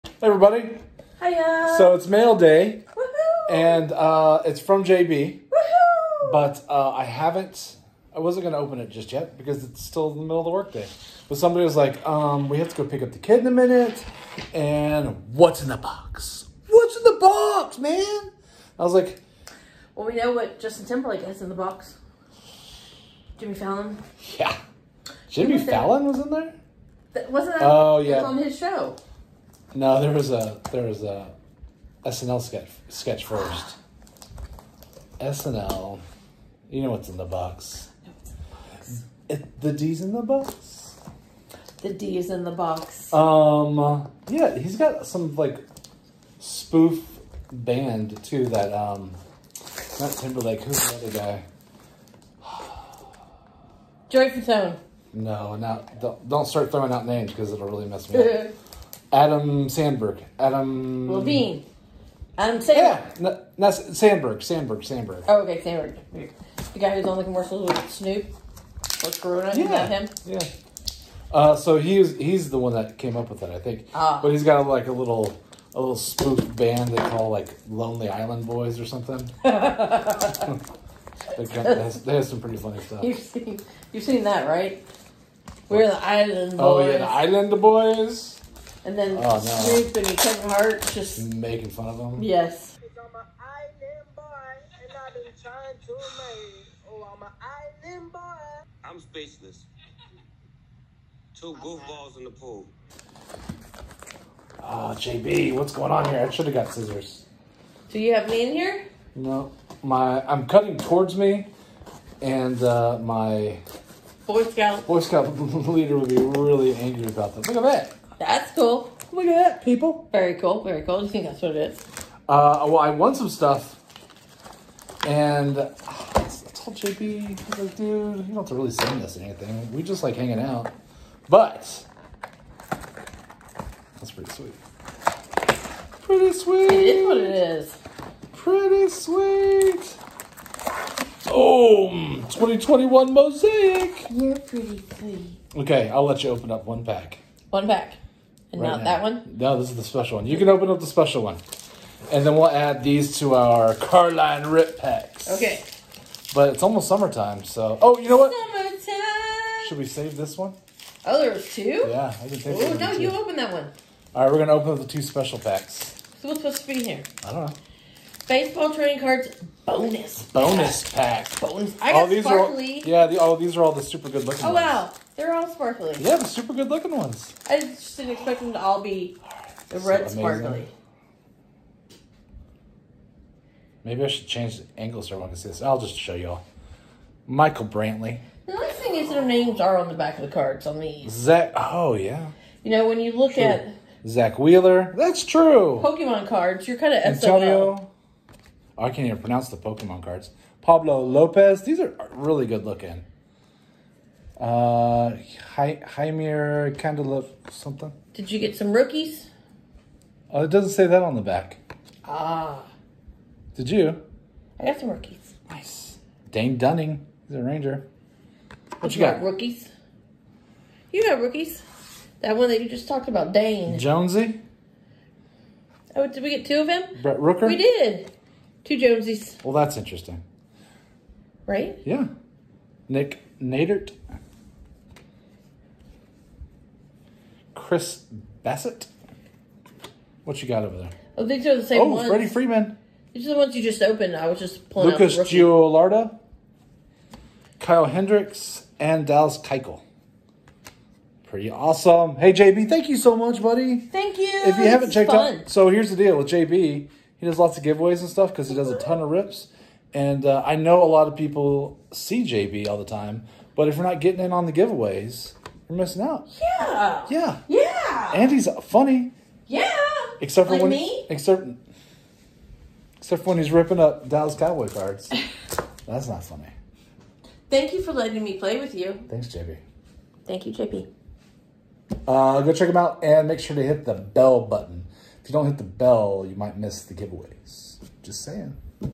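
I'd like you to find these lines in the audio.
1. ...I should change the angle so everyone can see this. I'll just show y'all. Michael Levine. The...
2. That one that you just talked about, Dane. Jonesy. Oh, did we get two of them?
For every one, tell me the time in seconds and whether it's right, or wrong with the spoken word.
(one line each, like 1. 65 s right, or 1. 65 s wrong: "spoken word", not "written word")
1. 184 s wrong: "Brantley", not "Levine"
2. 222 s right.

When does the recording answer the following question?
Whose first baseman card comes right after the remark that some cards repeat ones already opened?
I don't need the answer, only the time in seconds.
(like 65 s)
242 s.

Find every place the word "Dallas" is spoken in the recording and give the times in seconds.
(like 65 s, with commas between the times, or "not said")
249 s, 274 s.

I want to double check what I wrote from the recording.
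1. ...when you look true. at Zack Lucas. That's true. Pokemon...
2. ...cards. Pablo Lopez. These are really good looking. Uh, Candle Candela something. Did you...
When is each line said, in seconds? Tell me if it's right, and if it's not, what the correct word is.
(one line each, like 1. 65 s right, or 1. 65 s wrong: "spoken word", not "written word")
1. 192 s wrong: "Wheeler", not "Lucas"
2. 200 s right.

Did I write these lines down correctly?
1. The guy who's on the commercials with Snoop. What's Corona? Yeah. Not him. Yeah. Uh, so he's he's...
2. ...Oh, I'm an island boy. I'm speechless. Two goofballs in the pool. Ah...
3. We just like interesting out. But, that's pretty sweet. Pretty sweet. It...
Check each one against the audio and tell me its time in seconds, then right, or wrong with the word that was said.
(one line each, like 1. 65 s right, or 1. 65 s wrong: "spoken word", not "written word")
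1. 66 s right
2. 96 s right
3. 129 s wrong: "hanging", not "interesting".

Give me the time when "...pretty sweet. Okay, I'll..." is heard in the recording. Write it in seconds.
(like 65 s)
144 s.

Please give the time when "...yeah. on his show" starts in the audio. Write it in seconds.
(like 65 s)
27 s.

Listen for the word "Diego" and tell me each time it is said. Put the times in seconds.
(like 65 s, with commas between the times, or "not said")
not said.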